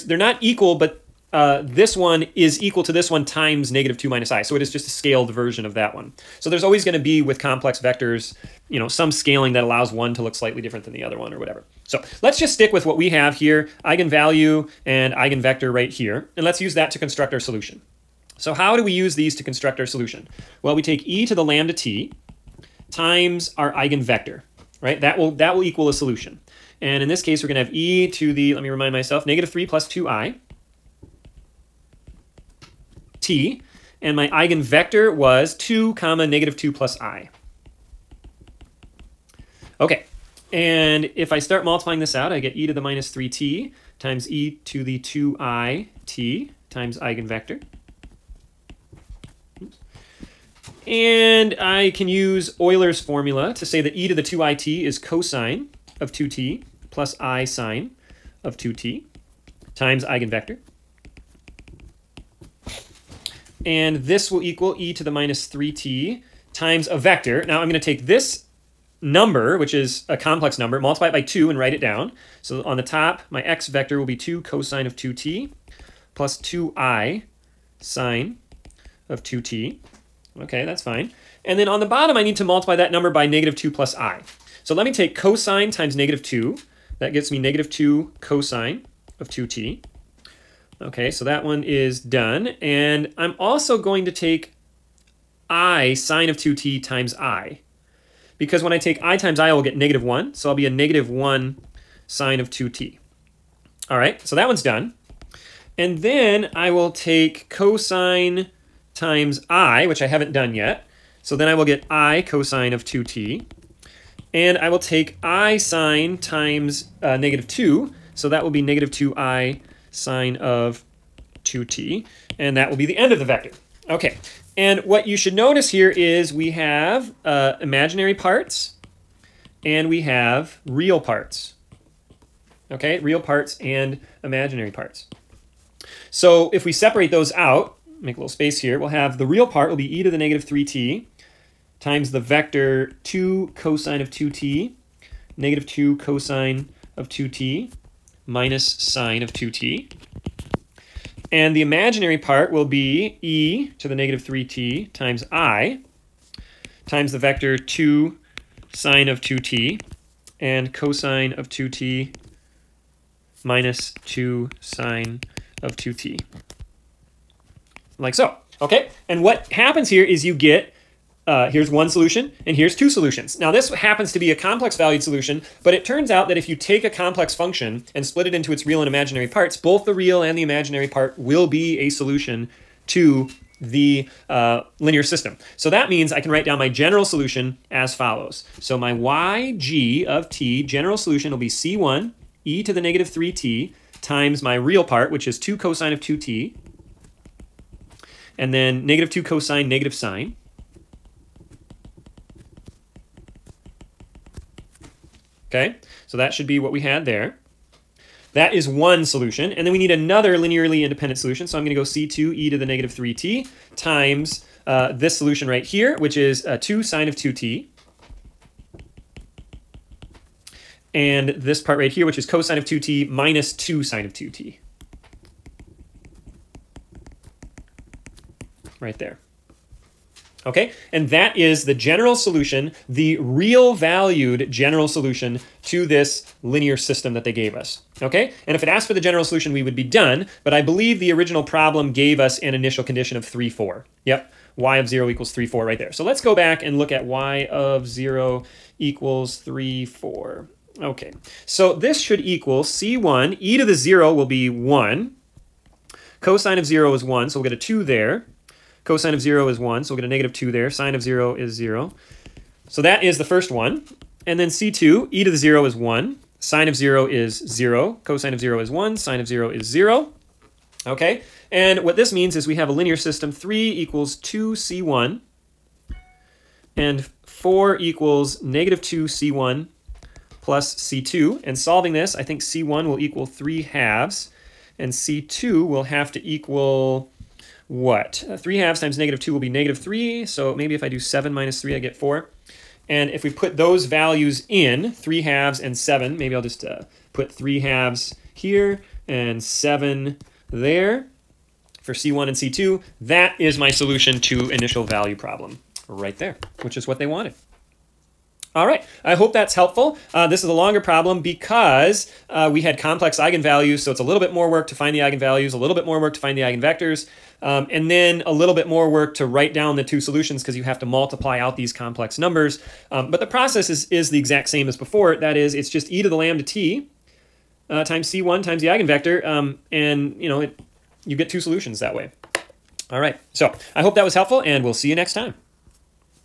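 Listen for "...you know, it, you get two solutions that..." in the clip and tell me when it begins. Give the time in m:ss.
5:30.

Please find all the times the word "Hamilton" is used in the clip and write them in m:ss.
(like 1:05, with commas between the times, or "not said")
not said.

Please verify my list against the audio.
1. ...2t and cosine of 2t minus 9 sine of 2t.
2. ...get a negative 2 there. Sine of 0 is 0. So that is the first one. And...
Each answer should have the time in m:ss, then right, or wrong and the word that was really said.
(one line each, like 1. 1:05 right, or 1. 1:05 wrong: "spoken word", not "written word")
1. 2:39 wrong: "2", not "9"
2. 4:19 right.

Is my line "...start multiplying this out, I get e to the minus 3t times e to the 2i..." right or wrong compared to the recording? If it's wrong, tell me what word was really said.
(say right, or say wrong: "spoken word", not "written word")
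right.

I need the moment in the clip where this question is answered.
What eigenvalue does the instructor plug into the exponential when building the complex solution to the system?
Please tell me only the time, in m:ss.
0:29.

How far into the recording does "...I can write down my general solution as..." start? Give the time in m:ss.
3:06.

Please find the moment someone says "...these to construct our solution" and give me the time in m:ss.
0:19.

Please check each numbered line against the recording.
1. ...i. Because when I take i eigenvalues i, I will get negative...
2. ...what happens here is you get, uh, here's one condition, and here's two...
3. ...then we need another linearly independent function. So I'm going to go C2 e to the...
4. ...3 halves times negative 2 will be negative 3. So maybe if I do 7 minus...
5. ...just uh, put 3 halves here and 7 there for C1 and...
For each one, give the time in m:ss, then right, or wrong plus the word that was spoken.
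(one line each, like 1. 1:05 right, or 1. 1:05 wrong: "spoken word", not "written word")
1. 1:37 wrong: "times", not "eigenvalues"
2. 2:49 wrong: "solution", not "condition"
3. 3:29 wrong: "solution", not "function"
4. 4:48 right
5. 4:56 right.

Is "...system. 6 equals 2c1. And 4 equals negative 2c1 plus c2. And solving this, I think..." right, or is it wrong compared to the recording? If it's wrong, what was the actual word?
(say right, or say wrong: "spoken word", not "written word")
wrong: "3", not "6".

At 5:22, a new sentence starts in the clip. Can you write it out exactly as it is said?
Um, but the process is, is the exact same as before.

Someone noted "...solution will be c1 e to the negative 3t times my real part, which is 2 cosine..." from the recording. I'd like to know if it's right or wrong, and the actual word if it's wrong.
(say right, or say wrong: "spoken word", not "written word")
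right.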